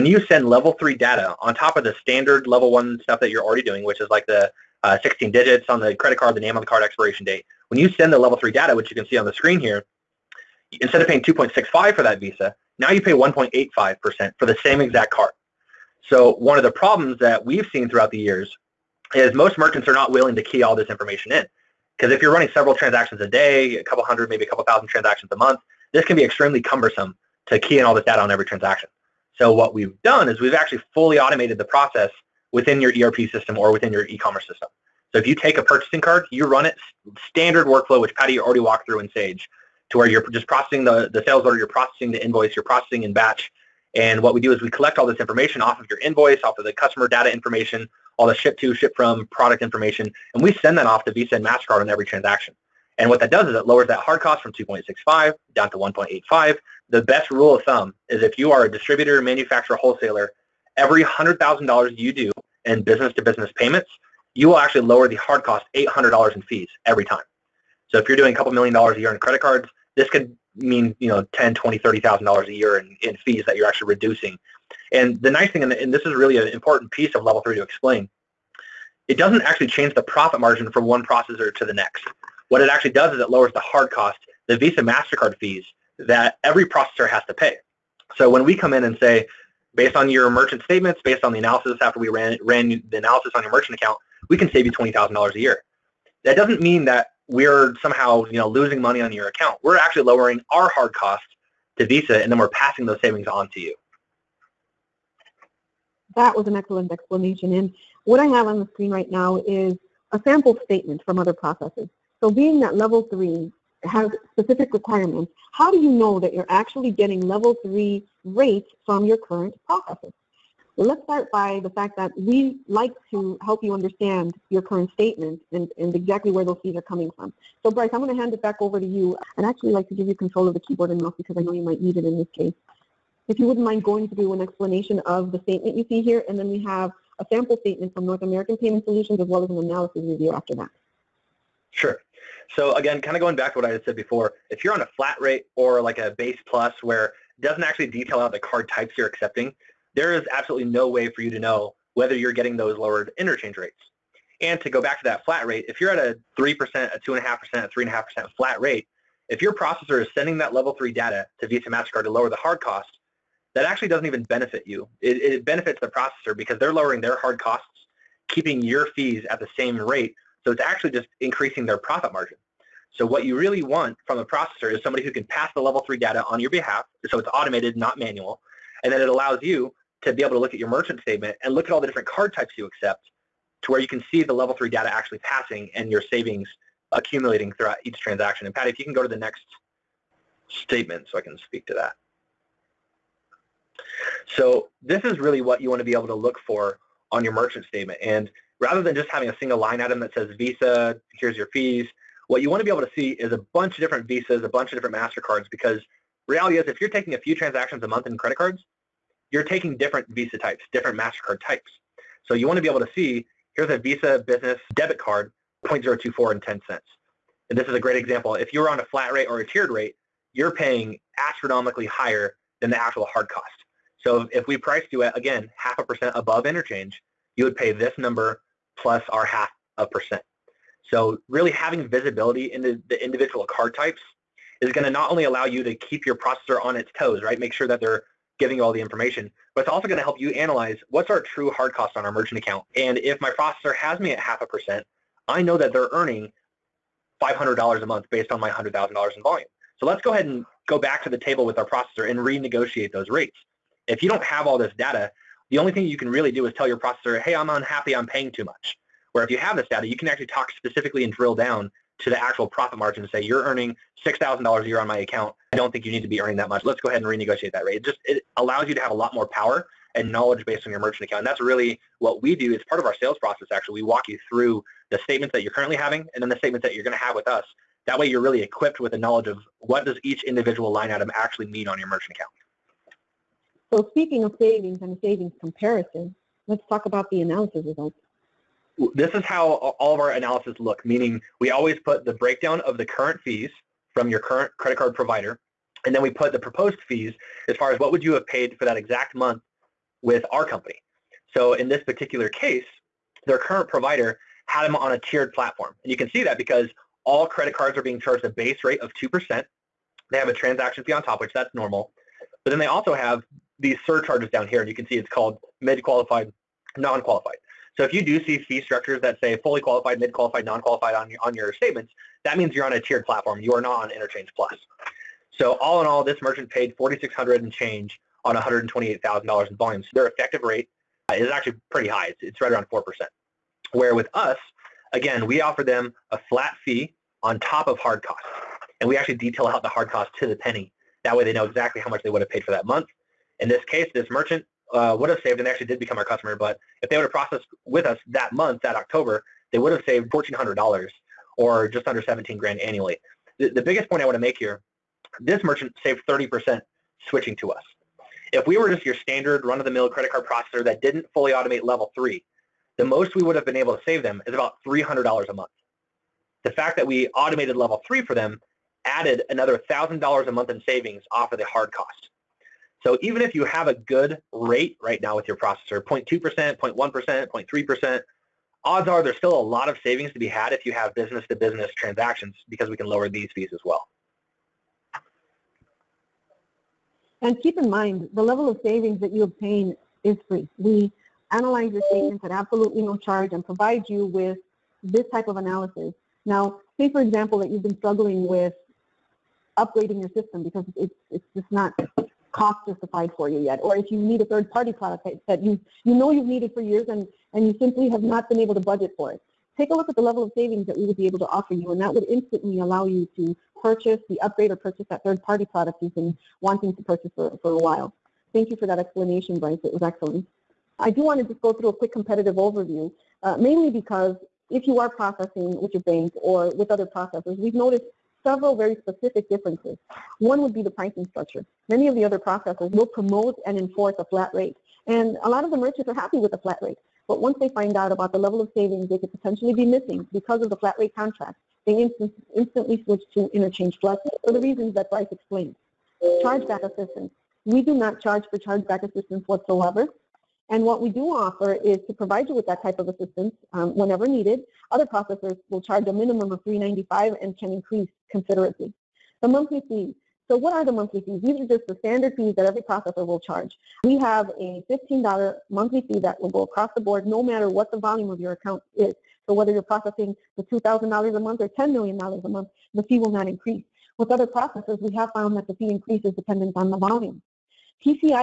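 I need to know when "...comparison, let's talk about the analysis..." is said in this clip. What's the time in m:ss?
4:45.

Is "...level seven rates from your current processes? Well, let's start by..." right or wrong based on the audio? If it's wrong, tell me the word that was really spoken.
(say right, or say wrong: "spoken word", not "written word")
wrong: "three", not "seven".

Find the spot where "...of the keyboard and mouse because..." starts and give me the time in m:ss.
2:10.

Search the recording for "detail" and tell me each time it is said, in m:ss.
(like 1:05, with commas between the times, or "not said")
2:27, 5:39.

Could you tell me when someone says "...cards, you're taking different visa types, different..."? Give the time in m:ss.
3:28.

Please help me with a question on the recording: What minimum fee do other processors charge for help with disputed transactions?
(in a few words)
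$395.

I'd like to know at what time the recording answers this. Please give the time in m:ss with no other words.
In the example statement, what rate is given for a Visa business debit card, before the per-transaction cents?
3:35.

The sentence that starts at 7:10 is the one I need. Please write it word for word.
One would be the pricing structure.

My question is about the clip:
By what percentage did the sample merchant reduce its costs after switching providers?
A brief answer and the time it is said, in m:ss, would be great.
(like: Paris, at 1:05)
30%, at 5:56.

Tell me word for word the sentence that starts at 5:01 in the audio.
So in this particular case, their current provider had them on a tiered platform.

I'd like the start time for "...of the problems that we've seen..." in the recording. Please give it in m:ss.
0:16.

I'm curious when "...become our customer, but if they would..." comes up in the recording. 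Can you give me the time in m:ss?
5:45.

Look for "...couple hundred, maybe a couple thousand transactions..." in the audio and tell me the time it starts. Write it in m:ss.
0:23.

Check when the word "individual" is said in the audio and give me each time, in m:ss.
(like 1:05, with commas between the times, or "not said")
3:53, 4:40.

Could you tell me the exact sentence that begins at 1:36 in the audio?
That doesn't mean that we're somehow you know losing money on your account.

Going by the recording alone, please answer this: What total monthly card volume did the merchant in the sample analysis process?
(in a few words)
$128,000.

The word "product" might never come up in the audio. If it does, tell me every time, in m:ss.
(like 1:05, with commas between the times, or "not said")
0:49, 6:44, 6:55.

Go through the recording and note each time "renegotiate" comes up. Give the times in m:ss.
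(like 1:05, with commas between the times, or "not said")
4:12, 4:27.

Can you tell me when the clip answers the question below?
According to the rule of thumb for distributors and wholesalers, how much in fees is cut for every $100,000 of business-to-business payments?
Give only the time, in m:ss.
1:05.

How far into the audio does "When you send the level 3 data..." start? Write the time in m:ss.
0:07.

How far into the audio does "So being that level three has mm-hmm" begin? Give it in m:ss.
1:52.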